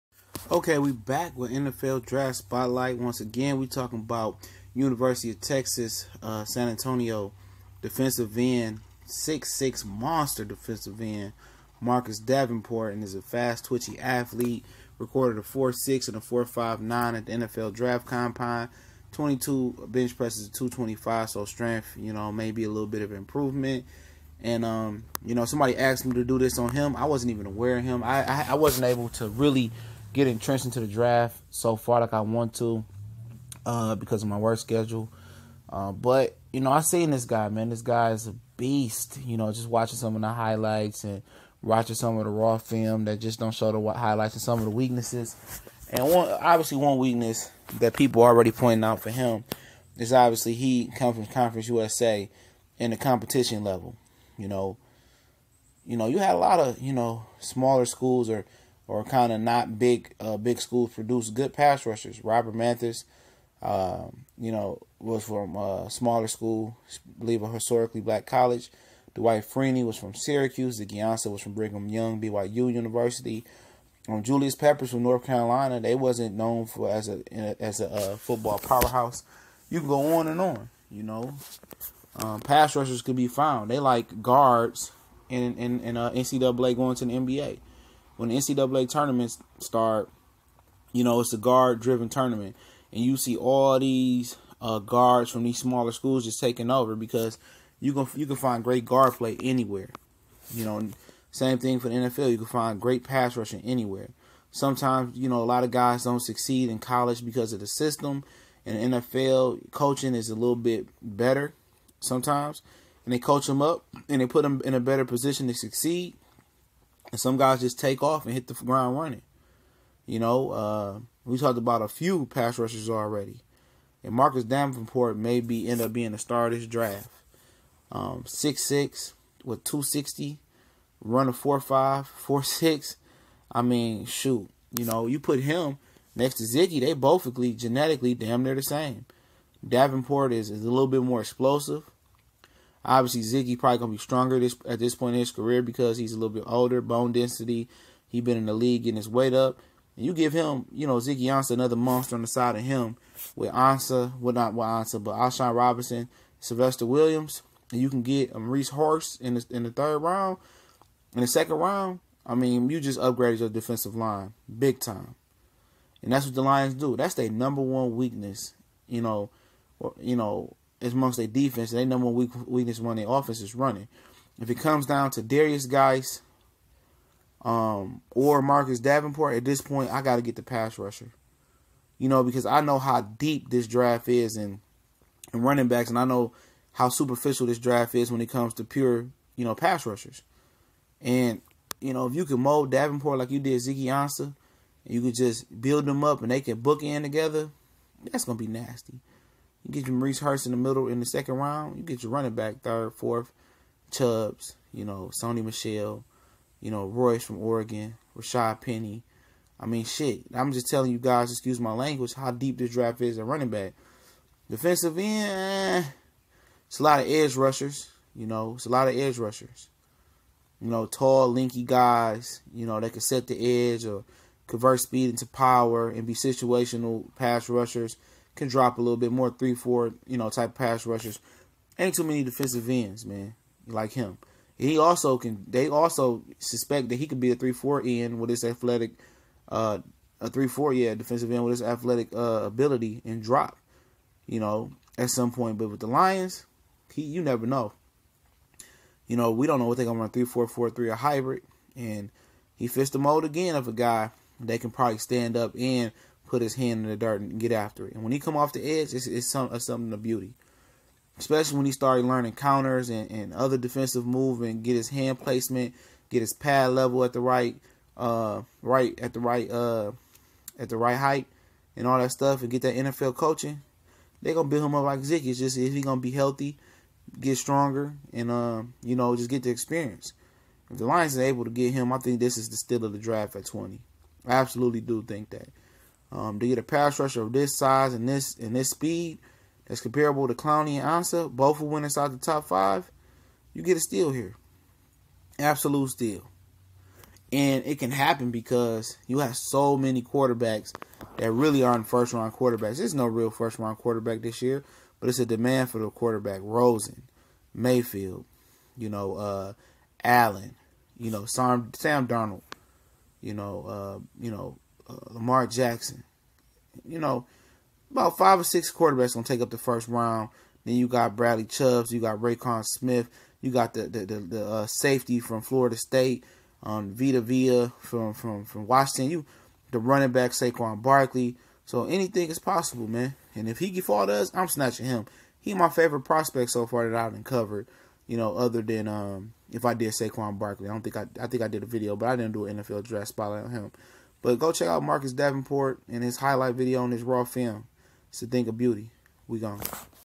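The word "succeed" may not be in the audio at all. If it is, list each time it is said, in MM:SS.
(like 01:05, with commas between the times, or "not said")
01:46, 01:55.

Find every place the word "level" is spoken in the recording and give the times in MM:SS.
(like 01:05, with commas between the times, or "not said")
00:53, 04:26.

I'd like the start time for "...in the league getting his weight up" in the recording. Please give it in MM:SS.
02:28.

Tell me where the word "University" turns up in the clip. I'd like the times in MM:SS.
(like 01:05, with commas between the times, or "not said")
00:04, 01:12.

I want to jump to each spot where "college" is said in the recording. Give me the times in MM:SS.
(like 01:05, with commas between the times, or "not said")
01:08, 01:46.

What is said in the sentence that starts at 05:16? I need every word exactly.
You know, about five or six quarterbacks gonna take up the first round.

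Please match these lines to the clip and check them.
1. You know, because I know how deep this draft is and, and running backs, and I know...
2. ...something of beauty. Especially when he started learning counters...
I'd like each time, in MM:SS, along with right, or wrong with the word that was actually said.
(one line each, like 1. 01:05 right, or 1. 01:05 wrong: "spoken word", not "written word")
1. 03:01 right
2. 04:19 right.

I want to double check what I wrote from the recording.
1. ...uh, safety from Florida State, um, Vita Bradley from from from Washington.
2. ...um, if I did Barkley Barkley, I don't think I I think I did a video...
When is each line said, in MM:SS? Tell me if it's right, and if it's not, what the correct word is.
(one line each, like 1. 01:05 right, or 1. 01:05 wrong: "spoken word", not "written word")
1. 05:24 wrong: "Vea", not "Bradley"
2. 05:38 wrong: "Saquon", not "Barkley".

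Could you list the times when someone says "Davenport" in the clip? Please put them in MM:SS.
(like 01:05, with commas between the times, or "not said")
00:12, 02:04, 02:19, 02:58, 03:12, 05:45.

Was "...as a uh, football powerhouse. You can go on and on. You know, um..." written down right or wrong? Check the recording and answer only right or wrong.
right.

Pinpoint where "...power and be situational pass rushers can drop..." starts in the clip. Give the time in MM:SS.
03:45.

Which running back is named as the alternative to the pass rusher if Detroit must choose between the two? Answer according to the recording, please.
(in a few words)
Derrius Guice.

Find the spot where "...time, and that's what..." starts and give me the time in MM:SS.
02:44.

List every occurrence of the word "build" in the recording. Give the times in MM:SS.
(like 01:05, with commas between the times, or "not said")
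03:15, 04:34.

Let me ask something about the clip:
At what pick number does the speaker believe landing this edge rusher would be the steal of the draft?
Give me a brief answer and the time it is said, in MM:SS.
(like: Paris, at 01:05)
20, at 04:43.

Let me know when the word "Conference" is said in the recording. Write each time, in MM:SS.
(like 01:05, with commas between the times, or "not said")
00:51.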